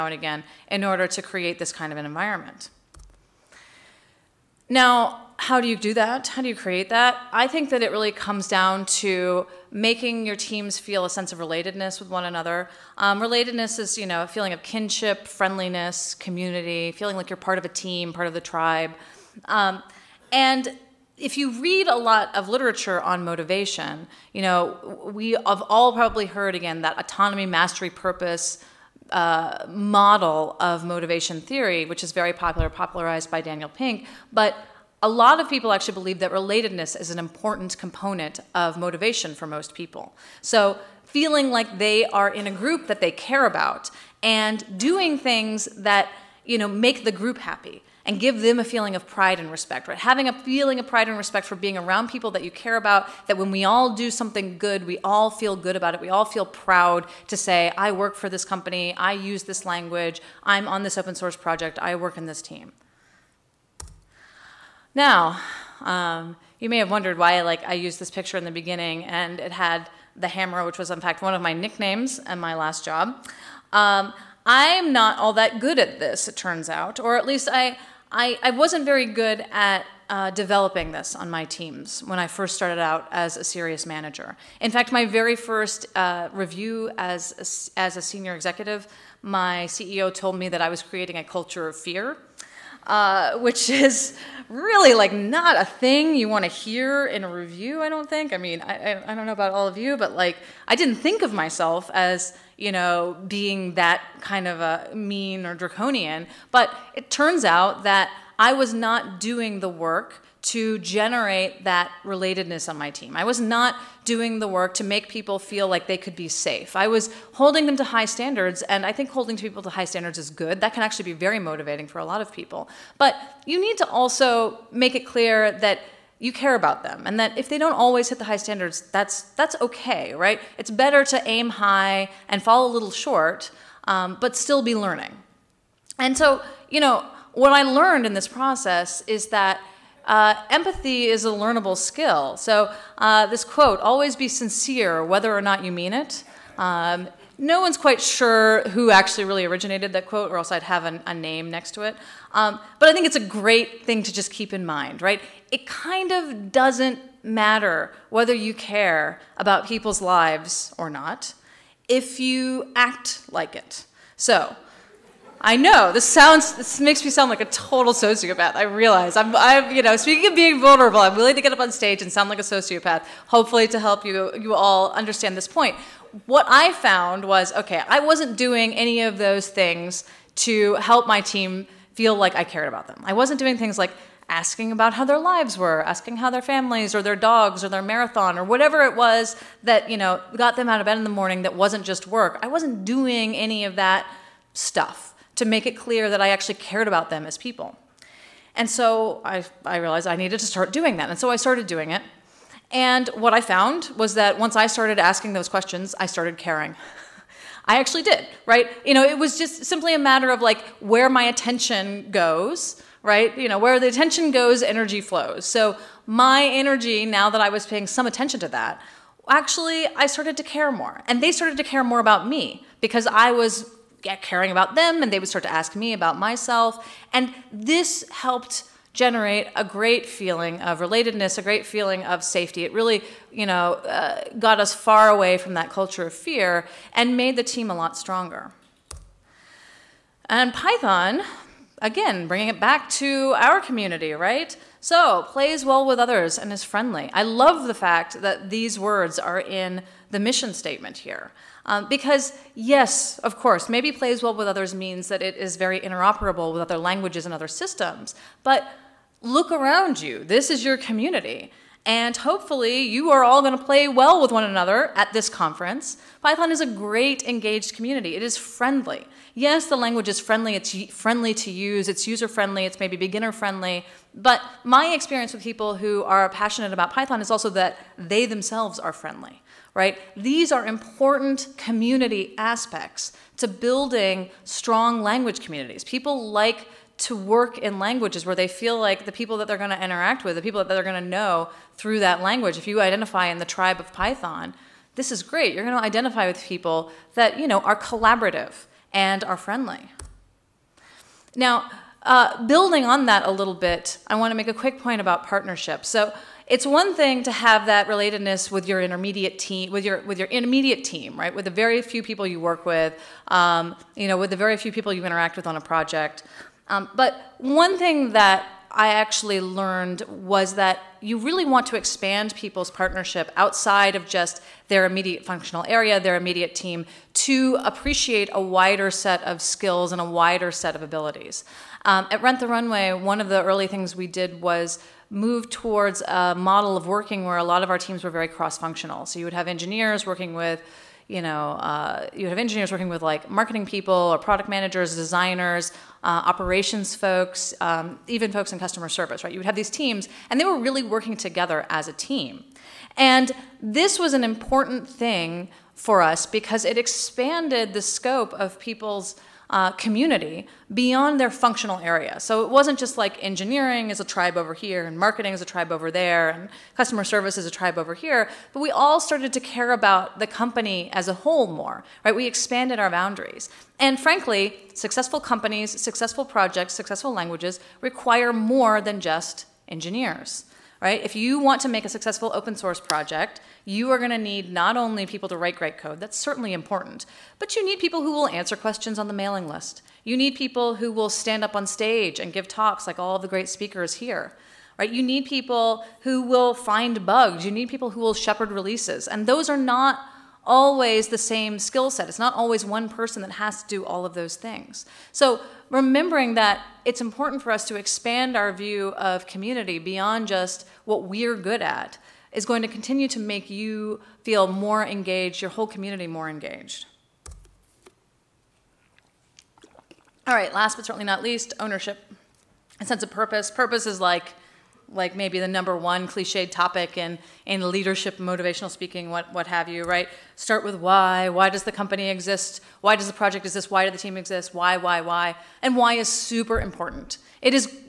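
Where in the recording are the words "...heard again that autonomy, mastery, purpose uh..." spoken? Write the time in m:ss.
0:26.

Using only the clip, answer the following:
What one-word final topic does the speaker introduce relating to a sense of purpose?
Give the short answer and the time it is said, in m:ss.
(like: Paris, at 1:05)
Ownership, at 7:01.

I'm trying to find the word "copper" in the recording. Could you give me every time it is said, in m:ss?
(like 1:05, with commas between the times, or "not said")
not said.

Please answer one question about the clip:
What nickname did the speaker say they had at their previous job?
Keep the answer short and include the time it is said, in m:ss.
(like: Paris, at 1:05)
The Hammer, at 1:10.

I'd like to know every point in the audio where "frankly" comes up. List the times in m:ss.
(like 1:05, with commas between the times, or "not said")
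6:13.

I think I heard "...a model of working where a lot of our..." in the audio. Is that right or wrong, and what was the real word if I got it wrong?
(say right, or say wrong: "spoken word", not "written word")
right.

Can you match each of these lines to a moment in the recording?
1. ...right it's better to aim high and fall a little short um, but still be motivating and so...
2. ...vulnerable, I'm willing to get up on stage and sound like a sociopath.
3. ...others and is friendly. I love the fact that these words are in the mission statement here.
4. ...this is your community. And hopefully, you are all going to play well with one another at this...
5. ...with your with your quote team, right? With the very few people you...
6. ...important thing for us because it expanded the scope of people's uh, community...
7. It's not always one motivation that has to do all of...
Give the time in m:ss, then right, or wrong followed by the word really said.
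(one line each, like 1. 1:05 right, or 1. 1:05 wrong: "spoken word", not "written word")
1. 2:10 wrong: "learning", not "motivating"
2. 2:50 right
3. 4:05 right
4. 4:20 right
5. 5:09 wrong: "intermediate", not "quote"
6. 5:54 right
7. 6:42 wrong: "person", not "motivation".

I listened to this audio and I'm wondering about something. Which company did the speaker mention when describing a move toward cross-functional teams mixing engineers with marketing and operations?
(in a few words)
Rent the Runway.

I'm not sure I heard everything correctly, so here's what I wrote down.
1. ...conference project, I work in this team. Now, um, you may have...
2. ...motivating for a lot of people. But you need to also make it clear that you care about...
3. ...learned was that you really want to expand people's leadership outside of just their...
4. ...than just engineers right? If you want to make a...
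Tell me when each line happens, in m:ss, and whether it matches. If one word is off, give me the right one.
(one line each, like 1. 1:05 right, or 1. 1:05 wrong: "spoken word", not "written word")
1. 1:01 wrong: "source", not "conference"
2. 2:01 right
3. 5:19 wrong: "partnership", not "leadership"
4. 6:18 right.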